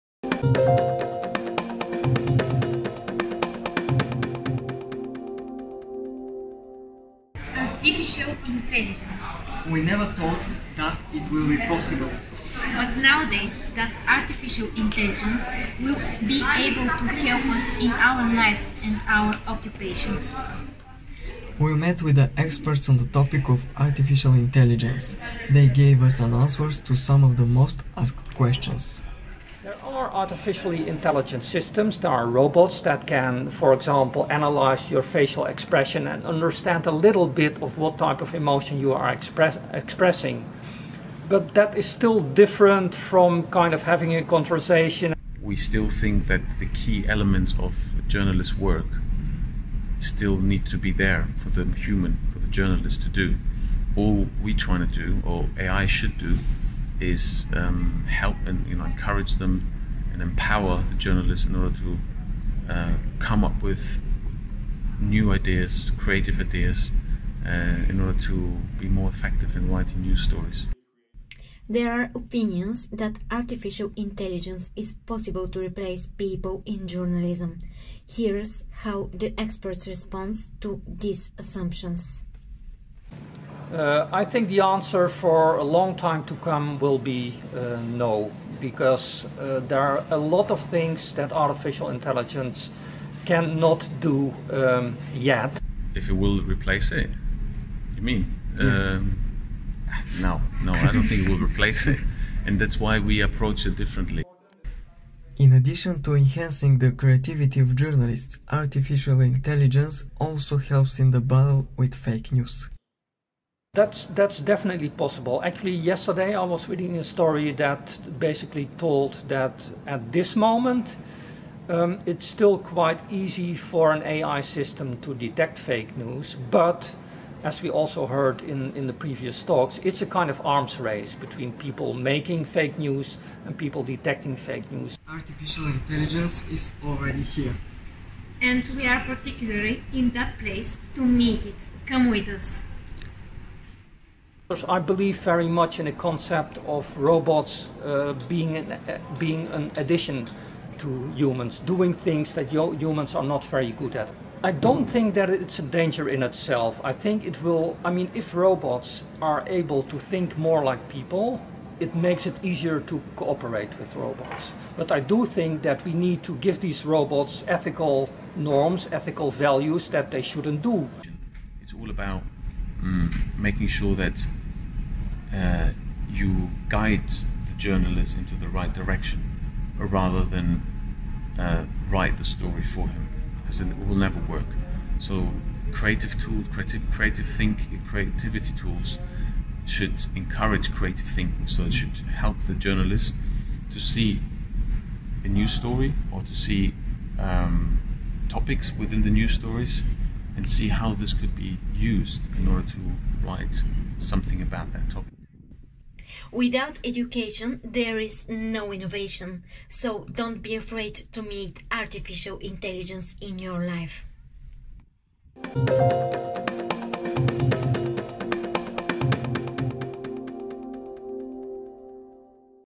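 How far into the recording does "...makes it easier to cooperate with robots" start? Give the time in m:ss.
2:41.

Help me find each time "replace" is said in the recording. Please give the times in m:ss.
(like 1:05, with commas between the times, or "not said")
1:15, 1:36, 1:41.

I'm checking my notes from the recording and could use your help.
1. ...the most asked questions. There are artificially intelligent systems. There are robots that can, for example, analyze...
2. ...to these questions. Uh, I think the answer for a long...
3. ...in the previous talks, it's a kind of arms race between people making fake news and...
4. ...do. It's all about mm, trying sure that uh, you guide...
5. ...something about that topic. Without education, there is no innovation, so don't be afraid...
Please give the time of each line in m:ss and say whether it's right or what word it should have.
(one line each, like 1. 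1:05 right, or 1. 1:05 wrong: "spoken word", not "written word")
1. 0:27 right
2. 1:20 wrong: "assumptions", not "questions"
3. 2:08 right
4. 2:50 wrong: "making", not "trying"
5. 3:23 right.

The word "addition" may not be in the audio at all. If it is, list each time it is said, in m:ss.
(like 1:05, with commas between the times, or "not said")
1:45, 2:29.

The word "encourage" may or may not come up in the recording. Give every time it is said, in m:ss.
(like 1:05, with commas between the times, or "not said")
0:58, 3:10.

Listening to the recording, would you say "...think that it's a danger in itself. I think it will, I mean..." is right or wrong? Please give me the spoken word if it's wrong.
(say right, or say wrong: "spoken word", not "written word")
right.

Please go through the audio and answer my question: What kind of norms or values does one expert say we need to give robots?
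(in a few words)
Ethical norms.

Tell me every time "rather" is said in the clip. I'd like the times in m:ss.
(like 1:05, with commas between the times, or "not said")
2:59.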